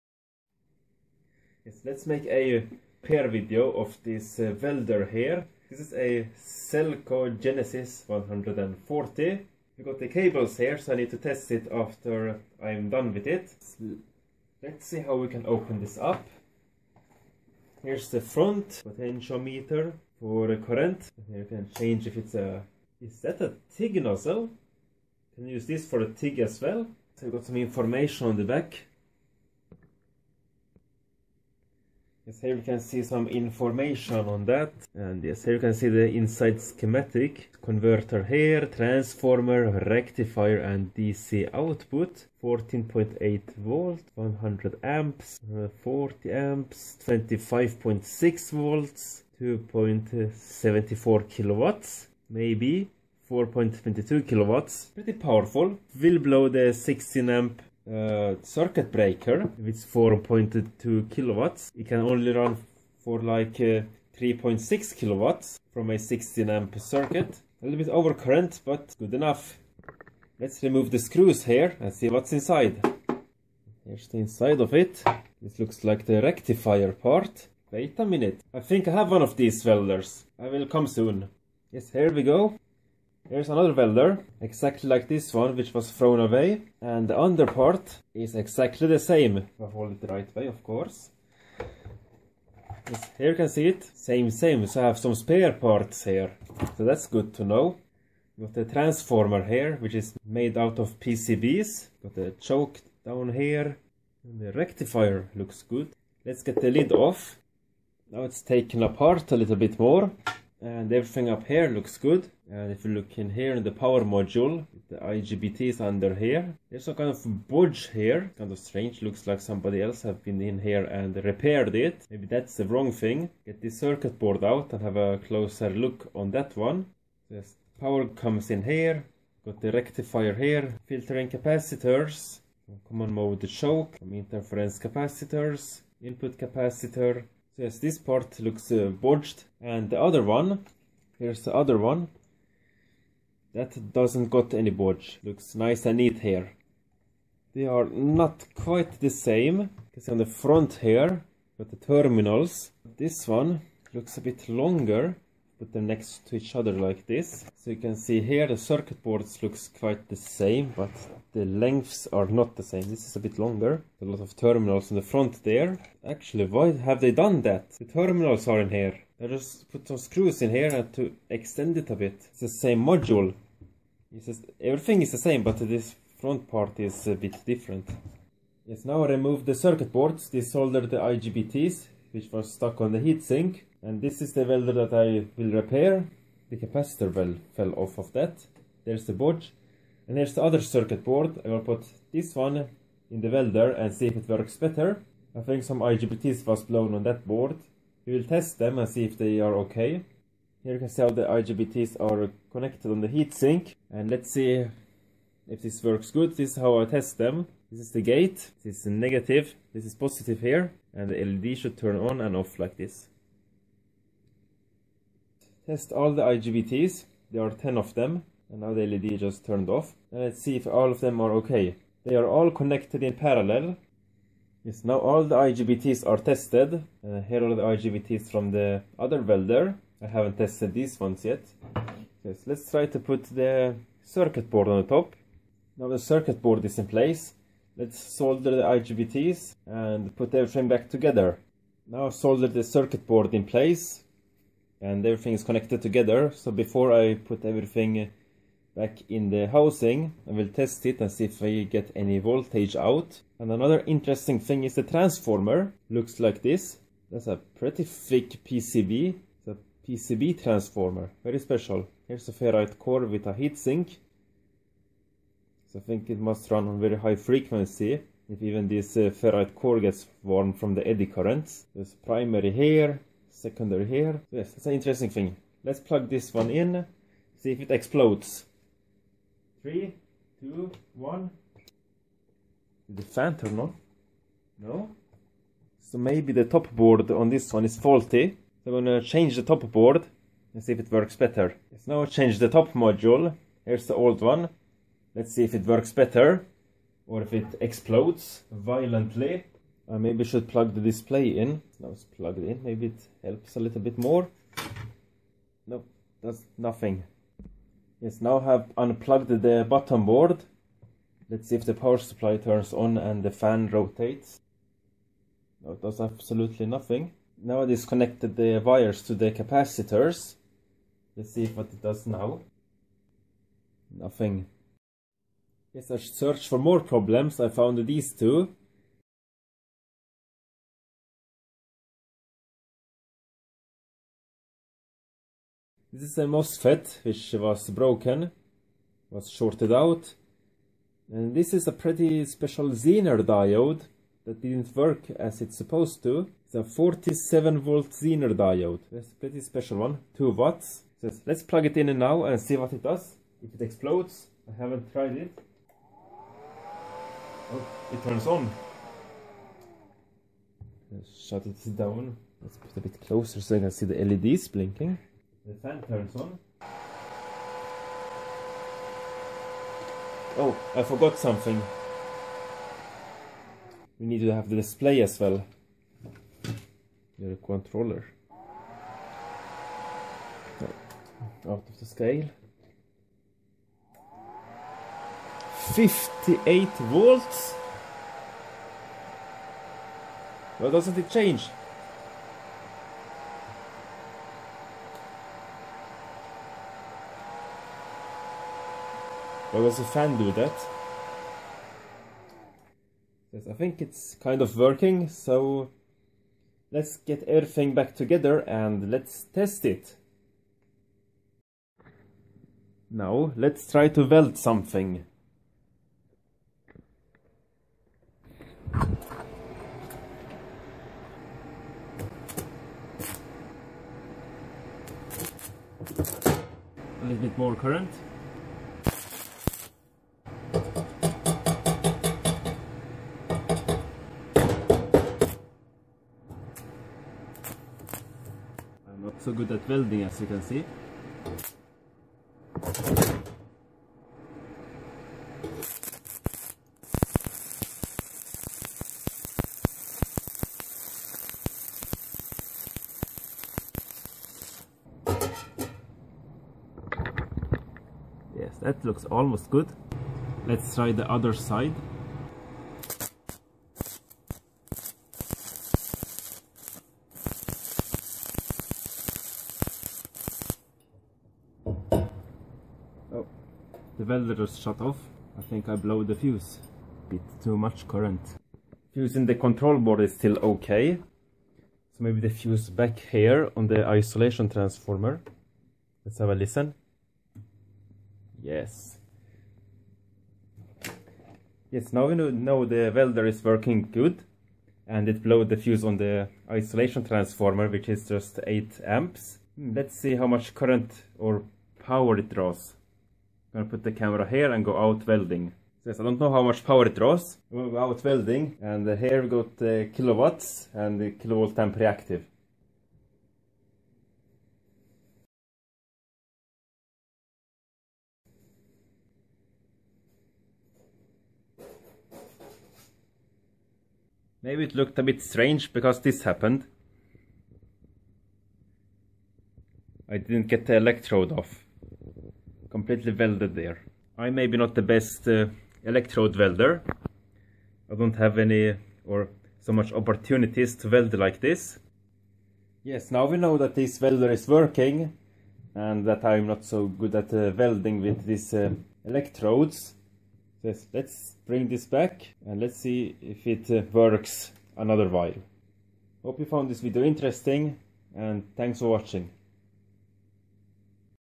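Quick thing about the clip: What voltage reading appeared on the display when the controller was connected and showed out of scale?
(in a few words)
58 volts.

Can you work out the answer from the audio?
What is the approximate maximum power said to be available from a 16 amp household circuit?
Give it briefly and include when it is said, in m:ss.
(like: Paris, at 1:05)
3.6 kilowatts, at 1:04.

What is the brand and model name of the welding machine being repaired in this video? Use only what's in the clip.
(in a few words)
Selco Genesis 140.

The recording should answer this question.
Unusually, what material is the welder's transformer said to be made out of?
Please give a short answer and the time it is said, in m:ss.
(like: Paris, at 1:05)
PCBs, at 1:40.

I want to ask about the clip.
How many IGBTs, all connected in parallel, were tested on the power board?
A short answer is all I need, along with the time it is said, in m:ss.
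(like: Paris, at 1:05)
10, at 3:37.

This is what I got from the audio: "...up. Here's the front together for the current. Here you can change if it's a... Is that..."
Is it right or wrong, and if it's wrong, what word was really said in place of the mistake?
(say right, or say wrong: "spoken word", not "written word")
wrong: "potentiometer", not "together".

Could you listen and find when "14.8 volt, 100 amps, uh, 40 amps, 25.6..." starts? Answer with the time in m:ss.
0:42.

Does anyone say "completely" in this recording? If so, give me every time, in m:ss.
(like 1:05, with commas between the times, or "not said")
8:52.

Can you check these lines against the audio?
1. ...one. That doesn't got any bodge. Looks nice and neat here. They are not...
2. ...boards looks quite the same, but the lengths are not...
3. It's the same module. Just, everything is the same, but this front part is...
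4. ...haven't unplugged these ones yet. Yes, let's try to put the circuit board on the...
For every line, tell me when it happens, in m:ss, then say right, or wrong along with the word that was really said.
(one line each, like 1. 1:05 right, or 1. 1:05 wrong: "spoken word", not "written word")
1. 2:21 right
2. 2:39 right
3. 2:52 right
4. 3:50 wrong: "tested", not "unplugged".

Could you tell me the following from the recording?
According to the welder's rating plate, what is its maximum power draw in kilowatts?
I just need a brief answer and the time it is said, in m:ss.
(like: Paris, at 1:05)
4.22 kilowatts, at 0:53.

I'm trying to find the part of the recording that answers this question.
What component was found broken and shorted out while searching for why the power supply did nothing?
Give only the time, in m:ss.
5:36.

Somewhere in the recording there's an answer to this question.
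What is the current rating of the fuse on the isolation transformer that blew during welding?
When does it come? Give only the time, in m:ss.
8:18.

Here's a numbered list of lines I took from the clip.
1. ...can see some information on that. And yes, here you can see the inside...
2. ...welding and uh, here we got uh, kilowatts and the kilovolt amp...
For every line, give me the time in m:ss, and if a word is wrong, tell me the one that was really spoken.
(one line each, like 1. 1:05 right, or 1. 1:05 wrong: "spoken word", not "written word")
1. 0:32 right
2. 8:28 right.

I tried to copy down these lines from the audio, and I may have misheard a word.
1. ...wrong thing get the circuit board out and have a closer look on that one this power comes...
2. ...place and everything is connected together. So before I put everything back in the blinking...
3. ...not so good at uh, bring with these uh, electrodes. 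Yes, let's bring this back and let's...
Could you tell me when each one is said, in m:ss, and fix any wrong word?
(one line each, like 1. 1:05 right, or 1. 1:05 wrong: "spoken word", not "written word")
1. 2:02 right
2. 4:03 wrong: "housing", not "blinking"
3. 9:06 wrong: "welding", not "bring".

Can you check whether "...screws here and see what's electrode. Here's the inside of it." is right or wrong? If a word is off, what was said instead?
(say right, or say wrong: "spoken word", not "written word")
wrong: "inside", not "electrode".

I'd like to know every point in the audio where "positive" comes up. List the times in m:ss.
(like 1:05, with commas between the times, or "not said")
3:29.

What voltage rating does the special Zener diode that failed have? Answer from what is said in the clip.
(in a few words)
47 volt.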